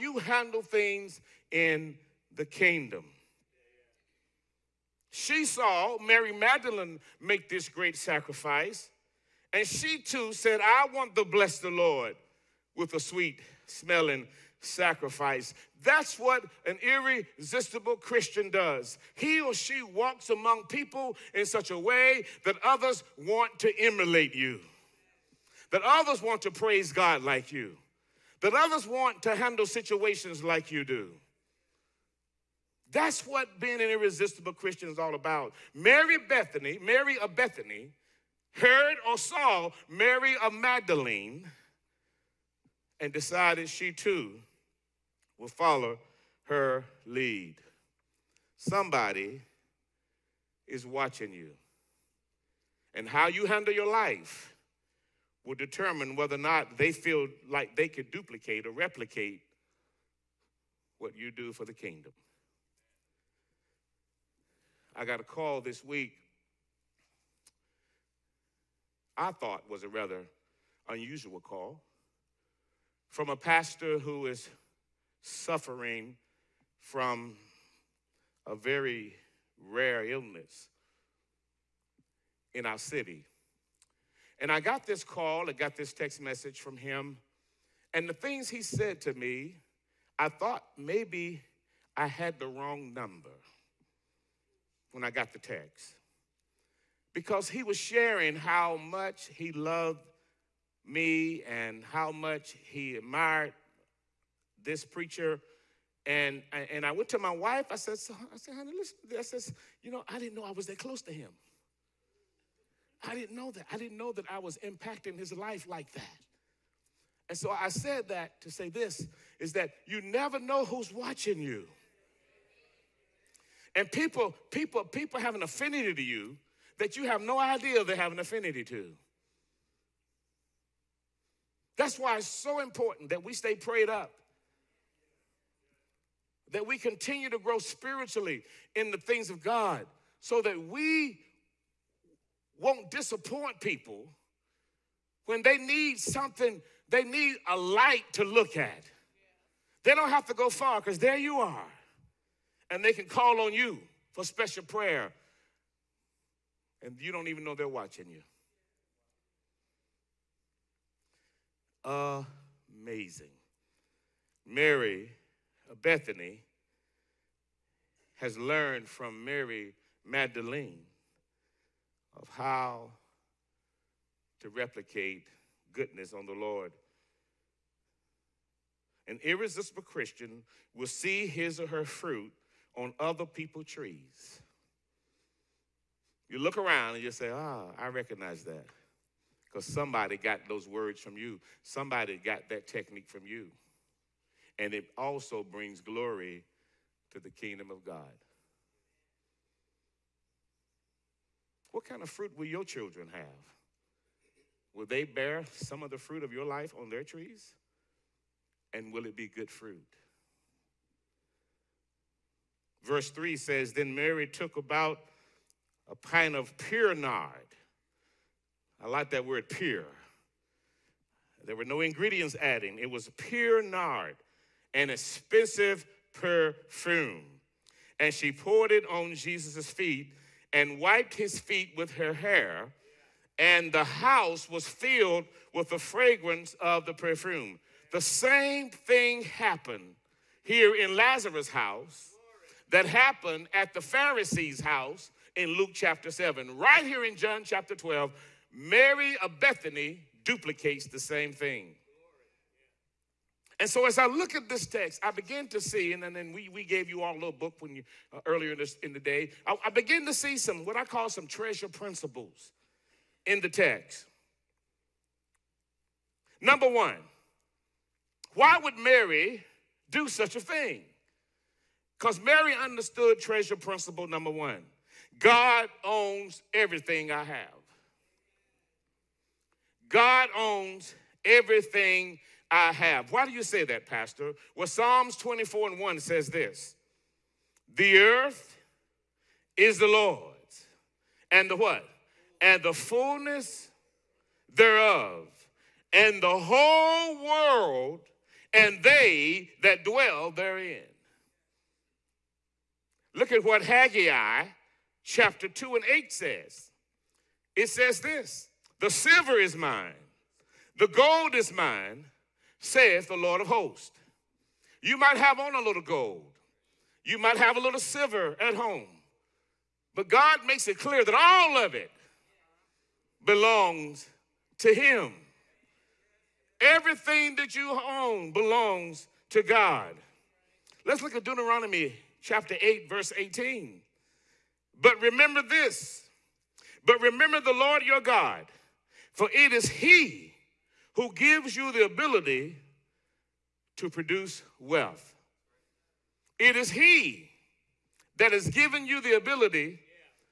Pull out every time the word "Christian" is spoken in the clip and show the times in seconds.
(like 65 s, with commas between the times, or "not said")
17 s, 34 s, 179 s.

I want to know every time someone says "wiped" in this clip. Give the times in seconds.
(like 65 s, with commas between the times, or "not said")
230 s.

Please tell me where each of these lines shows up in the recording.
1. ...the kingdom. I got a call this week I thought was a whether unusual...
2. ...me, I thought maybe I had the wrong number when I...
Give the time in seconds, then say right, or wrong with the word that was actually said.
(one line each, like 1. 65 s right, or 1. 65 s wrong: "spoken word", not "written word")
1. 61 s wrong: "rather", not "whether"
2. 89 s right.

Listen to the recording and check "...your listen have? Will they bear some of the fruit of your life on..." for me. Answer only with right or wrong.
wrong.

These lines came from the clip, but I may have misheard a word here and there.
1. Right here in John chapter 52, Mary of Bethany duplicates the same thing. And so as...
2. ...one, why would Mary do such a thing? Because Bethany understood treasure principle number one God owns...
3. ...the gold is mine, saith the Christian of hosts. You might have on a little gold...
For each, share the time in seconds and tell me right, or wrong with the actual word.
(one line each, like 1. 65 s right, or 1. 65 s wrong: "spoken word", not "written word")
1. 246 s wrong: "12", not "52"
2. 266 s wrong: "Mary", not "Bethany"
3. 310 s wrong: "Lord", not "Christian".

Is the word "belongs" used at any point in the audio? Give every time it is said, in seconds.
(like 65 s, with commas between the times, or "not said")
323 s, 328 s.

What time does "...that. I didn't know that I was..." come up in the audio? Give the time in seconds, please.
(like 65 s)
113 s.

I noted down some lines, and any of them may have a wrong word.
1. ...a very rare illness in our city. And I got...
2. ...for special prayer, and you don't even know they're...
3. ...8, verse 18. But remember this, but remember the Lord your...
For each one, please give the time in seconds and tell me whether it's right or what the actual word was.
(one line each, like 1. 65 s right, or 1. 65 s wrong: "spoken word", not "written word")
1. 78 s right
2. 154 s right
3. 332 s right.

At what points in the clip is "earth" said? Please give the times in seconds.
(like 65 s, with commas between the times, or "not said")
287 s.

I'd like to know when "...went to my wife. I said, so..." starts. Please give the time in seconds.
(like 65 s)
106 s.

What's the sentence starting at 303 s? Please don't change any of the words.
Look at what Haggai chapter 2 and 8 says.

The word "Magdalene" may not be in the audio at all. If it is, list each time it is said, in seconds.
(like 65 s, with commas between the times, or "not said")
6 s, 40 s, 170 s.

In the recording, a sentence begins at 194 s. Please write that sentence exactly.
And it also brings glory to the kingdom of God.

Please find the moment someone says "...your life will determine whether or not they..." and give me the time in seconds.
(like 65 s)
53 s.